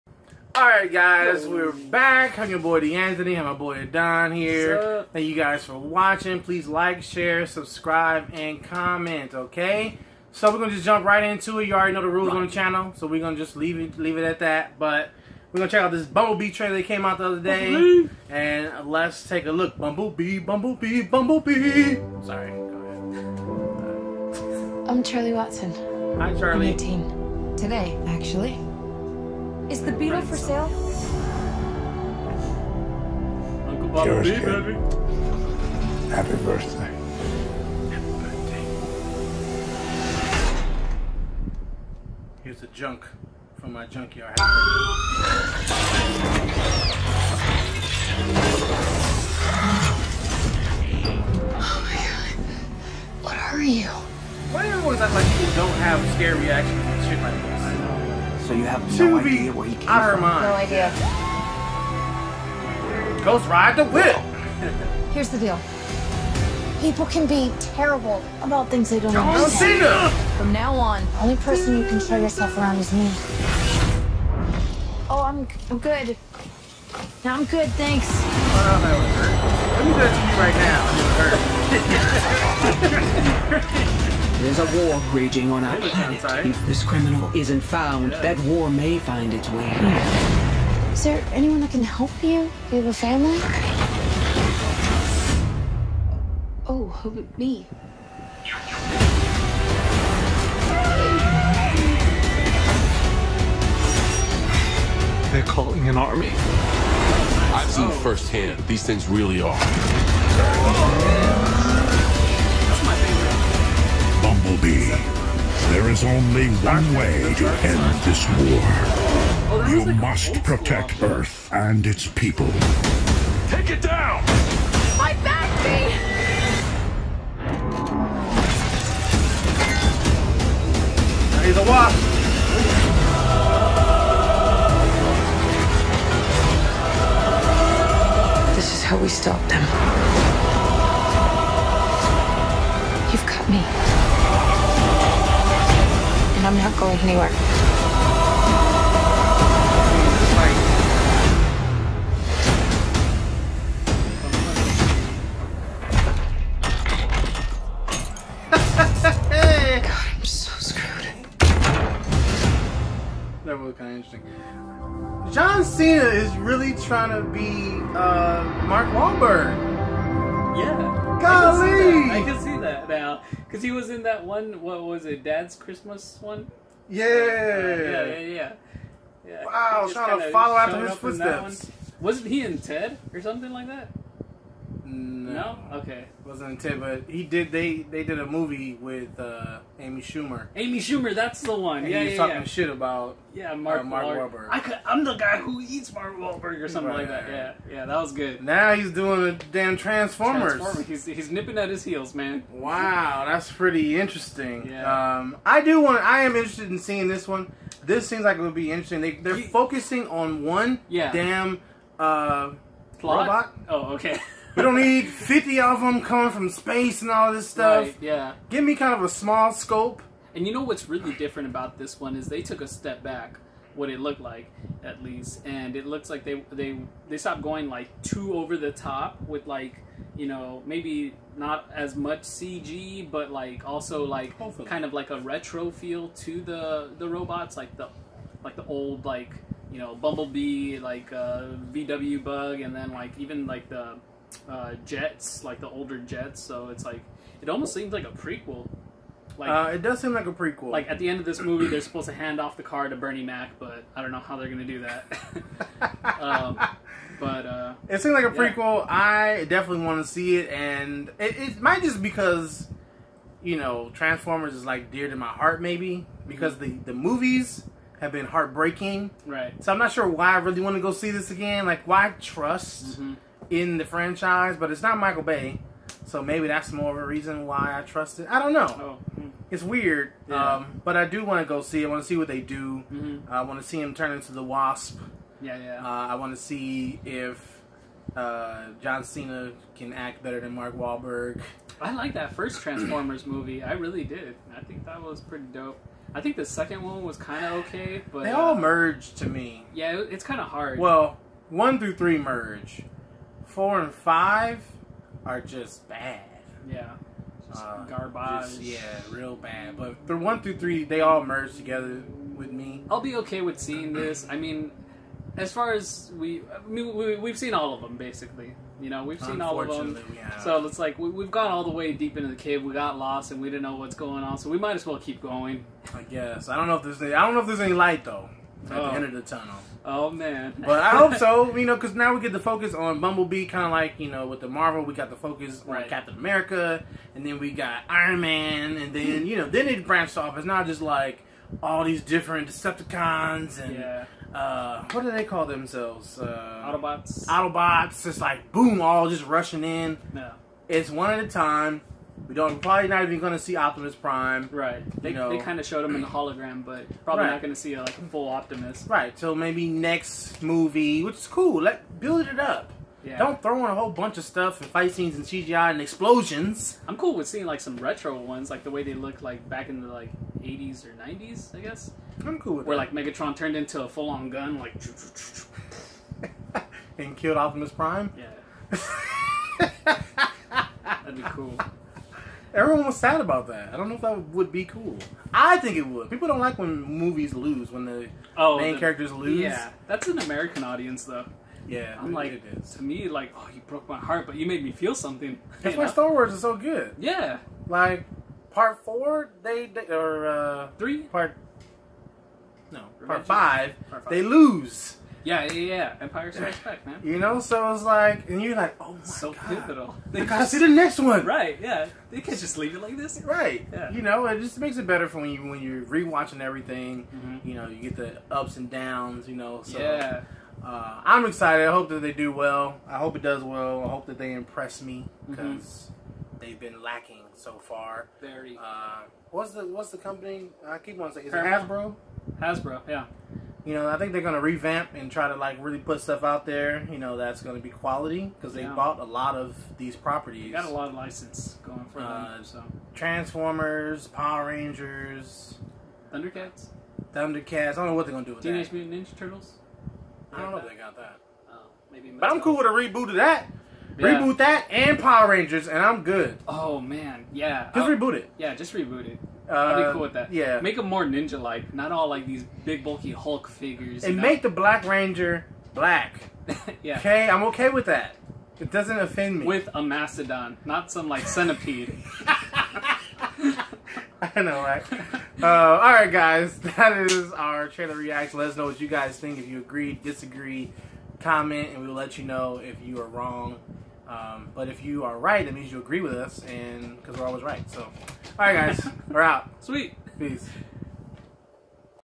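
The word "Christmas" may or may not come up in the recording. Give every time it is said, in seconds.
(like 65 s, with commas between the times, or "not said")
175 s.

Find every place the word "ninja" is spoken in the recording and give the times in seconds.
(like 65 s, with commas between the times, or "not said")
449 s, 461 s.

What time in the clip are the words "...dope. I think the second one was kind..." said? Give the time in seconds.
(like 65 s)
295 s.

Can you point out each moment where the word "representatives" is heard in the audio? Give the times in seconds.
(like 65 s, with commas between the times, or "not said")
not said.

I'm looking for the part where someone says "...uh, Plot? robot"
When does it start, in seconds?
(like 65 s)
211 s.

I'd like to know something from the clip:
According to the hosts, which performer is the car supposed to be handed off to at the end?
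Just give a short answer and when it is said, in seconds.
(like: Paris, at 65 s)
Bernie Mac, at 252 s.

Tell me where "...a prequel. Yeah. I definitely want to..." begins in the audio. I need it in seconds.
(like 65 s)
258 s.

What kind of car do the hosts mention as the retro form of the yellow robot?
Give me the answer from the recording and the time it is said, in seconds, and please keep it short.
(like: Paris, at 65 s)
VW bug, at 241 s.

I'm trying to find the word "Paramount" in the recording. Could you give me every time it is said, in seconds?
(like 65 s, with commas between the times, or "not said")
431 s.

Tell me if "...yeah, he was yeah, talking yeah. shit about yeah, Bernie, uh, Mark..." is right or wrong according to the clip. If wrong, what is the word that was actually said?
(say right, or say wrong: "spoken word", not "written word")
wrong: "Mark", not "Bernie".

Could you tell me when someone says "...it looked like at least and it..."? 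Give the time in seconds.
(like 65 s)
223 s.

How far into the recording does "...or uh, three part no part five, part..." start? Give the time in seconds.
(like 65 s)
399 s.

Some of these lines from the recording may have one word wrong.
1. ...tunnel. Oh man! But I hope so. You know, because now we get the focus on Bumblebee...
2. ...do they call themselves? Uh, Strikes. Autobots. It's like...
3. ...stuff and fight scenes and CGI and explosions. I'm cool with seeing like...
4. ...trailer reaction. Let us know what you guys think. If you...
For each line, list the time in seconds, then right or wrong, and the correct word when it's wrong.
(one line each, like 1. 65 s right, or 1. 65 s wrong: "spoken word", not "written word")
1. 329 s right
2. 345 s wrong: "Autobots", not "Strikes"
3. 364 s right
4. 477 s right.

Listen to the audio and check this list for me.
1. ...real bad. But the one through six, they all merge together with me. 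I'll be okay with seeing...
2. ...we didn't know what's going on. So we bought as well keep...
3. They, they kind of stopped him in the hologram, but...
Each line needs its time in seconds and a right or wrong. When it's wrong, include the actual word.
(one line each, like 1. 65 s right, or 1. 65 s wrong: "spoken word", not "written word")
1. 309 s wrong: "three", not "six"
2. 323 s wrong: "might", not "bought"
3. 355 s wrong: "showed", not "stopped".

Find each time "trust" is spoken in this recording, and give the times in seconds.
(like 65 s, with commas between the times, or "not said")
272 s, 277 s.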